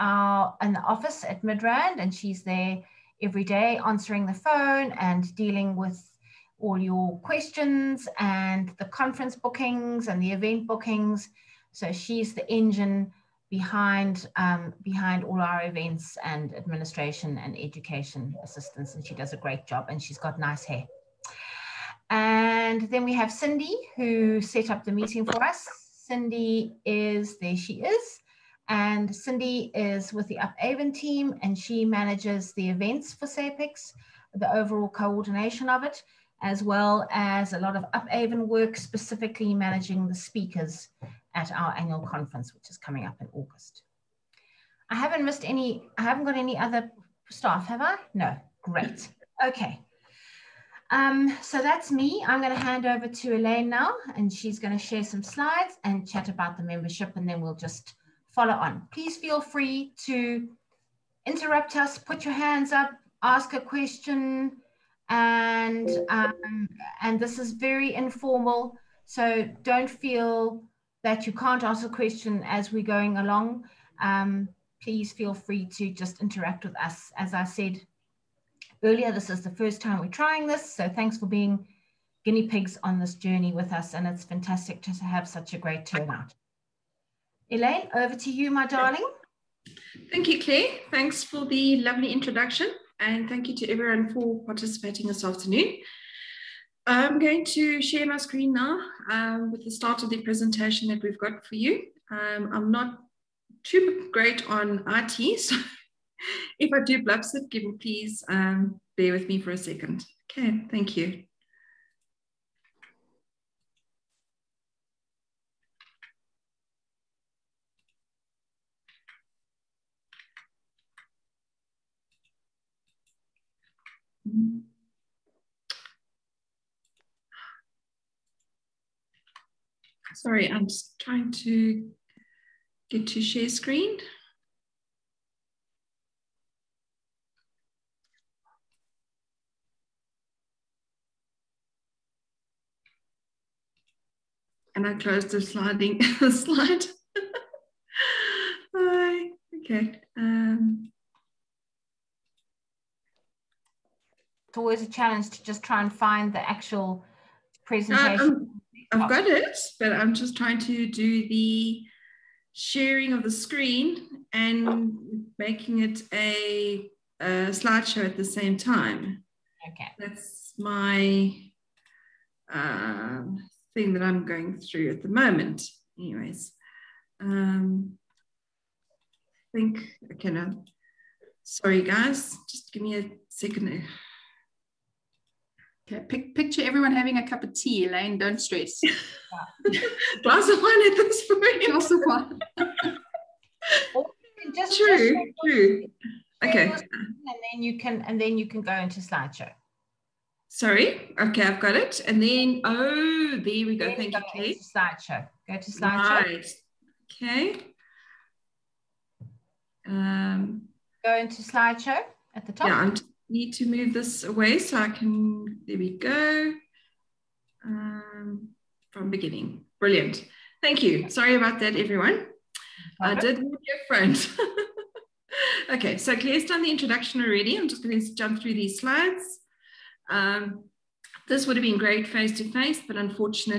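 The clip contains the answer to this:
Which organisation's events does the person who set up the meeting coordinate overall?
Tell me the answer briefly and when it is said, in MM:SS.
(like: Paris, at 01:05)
SAPICS, at 00:33.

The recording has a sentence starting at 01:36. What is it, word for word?
I'm going to share my screen now um, with the start of the presentation that we've got for you.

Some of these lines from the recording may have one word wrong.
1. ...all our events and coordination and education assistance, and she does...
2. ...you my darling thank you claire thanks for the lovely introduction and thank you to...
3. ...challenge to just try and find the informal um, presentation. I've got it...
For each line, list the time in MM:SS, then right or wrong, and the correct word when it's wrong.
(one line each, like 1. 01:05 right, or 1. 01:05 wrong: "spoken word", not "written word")
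1. 00:15 wrong: "administration", not "coordination"
2. 01:28 right
3. 02:34 wrong: "actual", not "informal".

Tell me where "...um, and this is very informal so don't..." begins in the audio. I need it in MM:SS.
01:06.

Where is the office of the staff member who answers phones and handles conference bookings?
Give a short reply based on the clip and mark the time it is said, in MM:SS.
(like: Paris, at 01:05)
Midrand, at 00:01.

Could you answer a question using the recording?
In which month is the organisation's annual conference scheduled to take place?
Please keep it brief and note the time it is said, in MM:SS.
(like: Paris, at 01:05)
August, at 00:43.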